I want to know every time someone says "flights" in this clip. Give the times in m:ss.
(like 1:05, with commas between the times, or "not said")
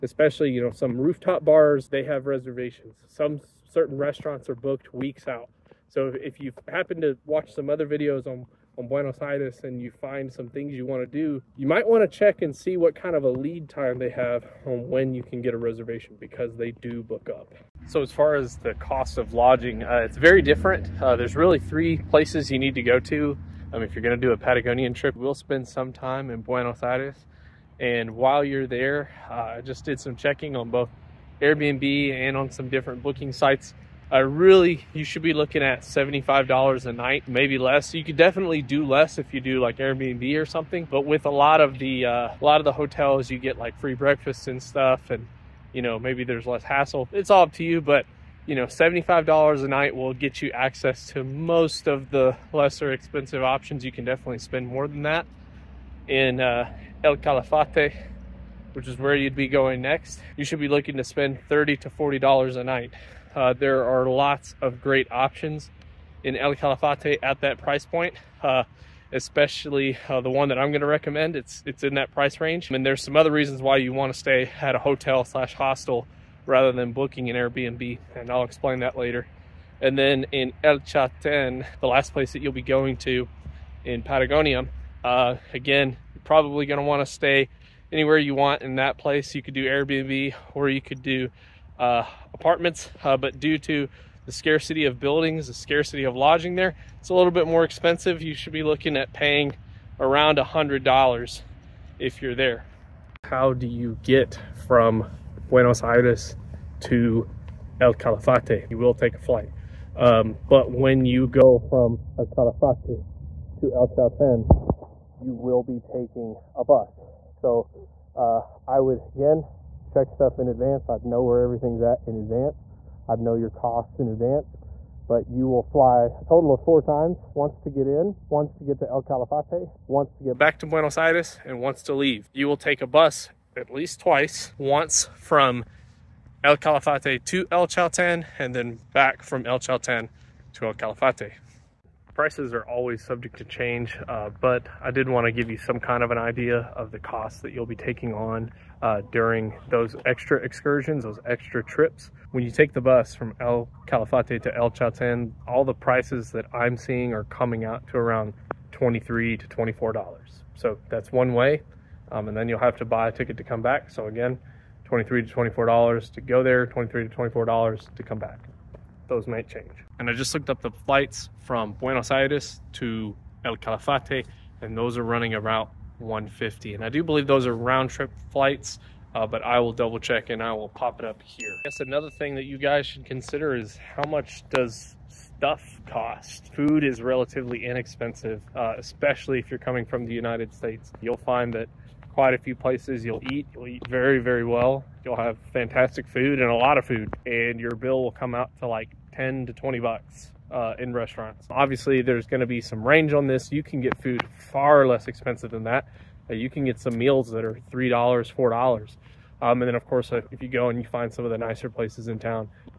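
1:49, 2:50, 2:58.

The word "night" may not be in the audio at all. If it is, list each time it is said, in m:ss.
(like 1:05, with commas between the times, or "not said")
0:36, 0:49, 1:02.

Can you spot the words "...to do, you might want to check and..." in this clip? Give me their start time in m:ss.
0:11.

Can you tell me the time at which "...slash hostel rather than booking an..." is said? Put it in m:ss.
1:15.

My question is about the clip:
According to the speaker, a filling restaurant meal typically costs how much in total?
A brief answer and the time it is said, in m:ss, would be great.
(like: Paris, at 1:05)
$10 to $20, at 3:19.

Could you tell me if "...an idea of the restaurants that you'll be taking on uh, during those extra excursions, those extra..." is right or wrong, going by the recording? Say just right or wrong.
wrong.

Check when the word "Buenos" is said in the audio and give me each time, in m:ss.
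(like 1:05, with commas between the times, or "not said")
0:08, 0:26, 1:45, 2:10, 2:51.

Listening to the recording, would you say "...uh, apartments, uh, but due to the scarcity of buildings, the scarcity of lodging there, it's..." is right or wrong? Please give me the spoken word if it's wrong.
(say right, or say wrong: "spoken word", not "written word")
right.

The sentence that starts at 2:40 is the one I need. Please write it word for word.
So that's one way, um, and then you'll have to buy a ticket to come back.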